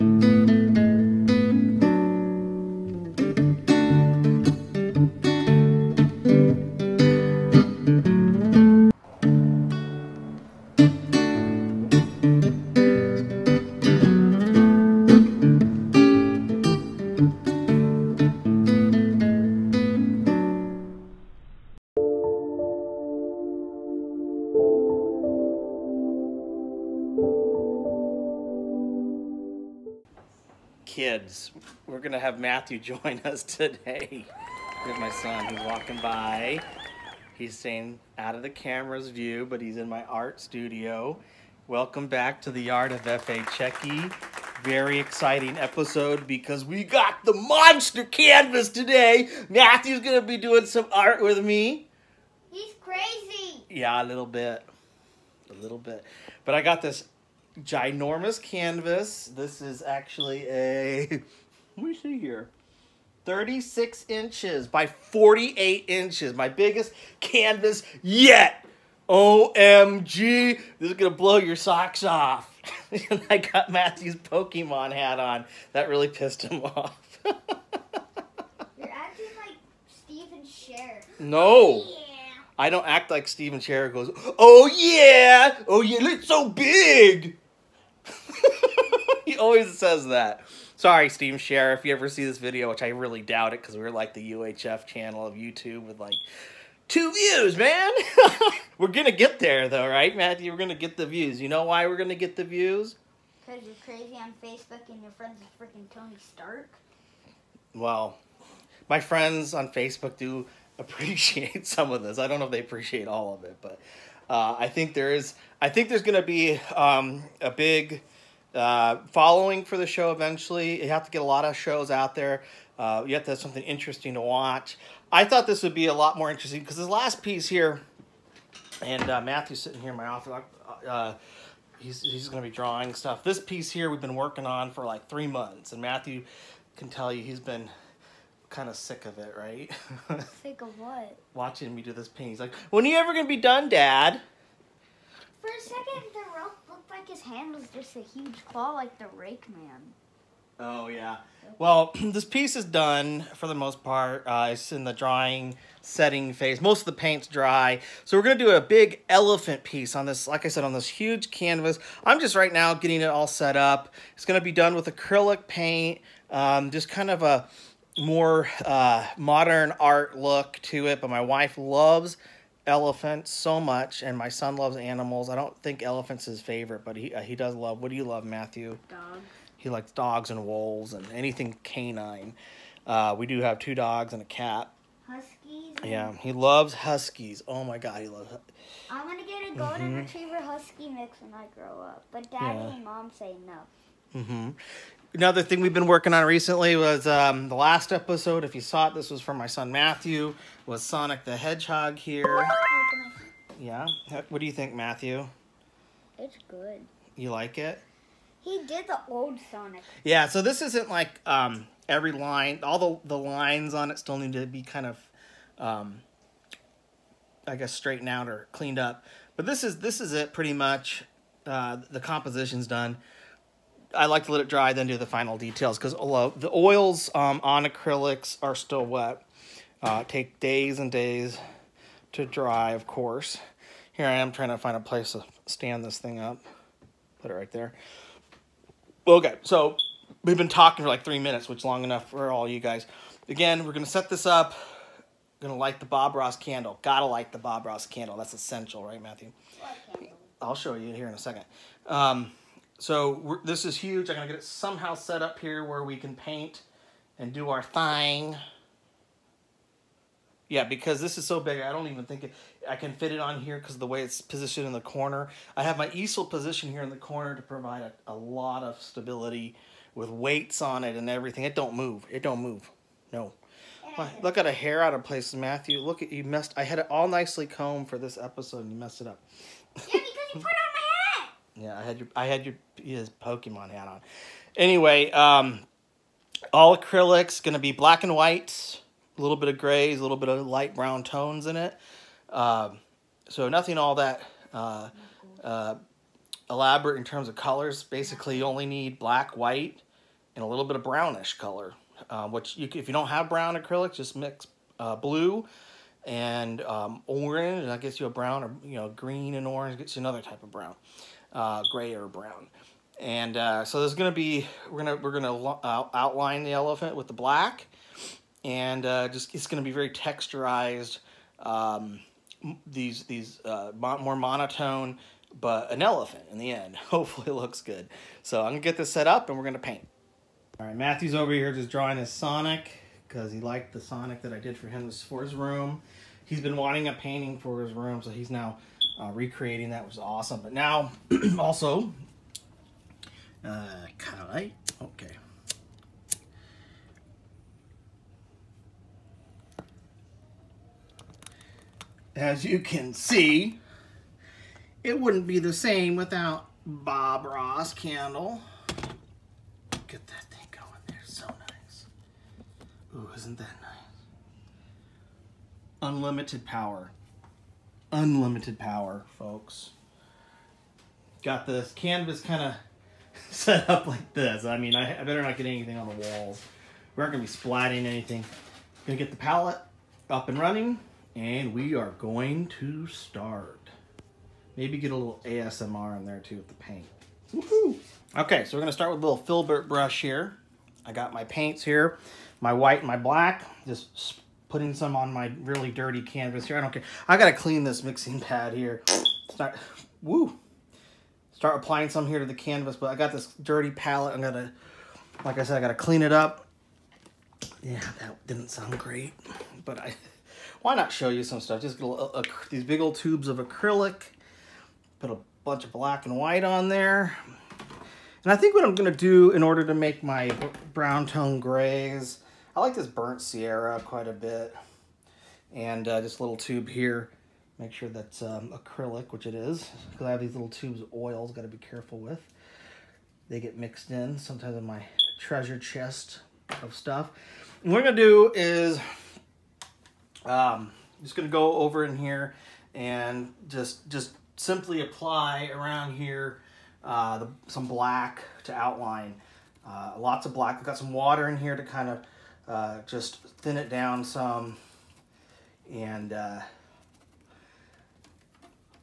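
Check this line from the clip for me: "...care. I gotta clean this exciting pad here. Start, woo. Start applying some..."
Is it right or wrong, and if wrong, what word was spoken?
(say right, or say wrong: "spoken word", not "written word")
wrong: "mixing", not "exciting".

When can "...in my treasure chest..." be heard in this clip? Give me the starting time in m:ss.
7:14.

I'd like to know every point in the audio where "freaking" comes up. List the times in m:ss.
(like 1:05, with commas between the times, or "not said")
1:45.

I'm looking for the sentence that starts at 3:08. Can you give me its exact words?
I am going to get a golden mm -hmm.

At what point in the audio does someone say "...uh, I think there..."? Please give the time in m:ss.
1:54.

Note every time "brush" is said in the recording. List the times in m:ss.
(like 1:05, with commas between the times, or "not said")
6:29.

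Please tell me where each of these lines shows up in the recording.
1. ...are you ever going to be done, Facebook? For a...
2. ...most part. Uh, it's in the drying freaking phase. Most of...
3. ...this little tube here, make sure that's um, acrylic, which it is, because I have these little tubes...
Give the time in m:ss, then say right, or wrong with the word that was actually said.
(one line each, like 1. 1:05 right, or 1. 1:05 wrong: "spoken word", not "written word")
1. 2:22 wrong: "Dad", not "Facebook"
2. 2:33 wrong: "setting", not "freaking"
3. 7:06 right.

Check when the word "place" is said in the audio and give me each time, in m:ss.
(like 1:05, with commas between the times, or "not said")
3:54, 4:35.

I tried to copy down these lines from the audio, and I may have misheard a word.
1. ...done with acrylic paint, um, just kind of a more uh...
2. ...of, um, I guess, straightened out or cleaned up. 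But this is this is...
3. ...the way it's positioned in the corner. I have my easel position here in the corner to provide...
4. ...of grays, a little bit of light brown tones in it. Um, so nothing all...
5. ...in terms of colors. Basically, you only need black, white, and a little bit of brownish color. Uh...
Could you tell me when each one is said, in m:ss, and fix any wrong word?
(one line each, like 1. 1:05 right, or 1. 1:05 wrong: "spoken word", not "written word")
1. 2:44 right
2. 3:34 right
3. 4:23 right
4. 4:49 right
5. 4:56 right.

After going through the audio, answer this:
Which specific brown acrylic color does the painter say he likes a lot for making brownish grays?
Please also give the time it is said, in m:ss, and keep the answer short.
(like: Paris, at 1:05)
Burnt sienna, at 7:02.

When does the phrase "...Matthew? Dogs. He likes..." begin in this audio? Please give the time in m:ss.
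2:58.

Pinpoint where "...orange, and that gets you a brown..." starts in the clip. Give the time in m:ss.
5:07.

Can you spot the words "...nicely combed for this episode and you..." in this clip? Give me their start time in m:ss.
4:37.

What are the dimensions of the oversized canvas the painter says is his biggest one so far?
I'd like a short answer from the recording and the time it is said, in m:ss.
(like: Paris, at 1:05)
36 inches by 48 inches, at 1:03.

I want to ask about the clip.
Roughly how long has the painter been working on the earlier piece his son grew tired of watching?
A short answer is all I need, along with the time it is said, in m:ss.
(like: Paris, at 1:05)
three months, at 2:15.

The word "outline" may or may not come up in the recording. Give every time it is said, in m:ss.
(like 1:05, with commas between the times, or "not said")
5:15, 7:28.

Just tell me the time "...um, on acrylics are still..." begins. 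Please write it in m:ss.
3:47.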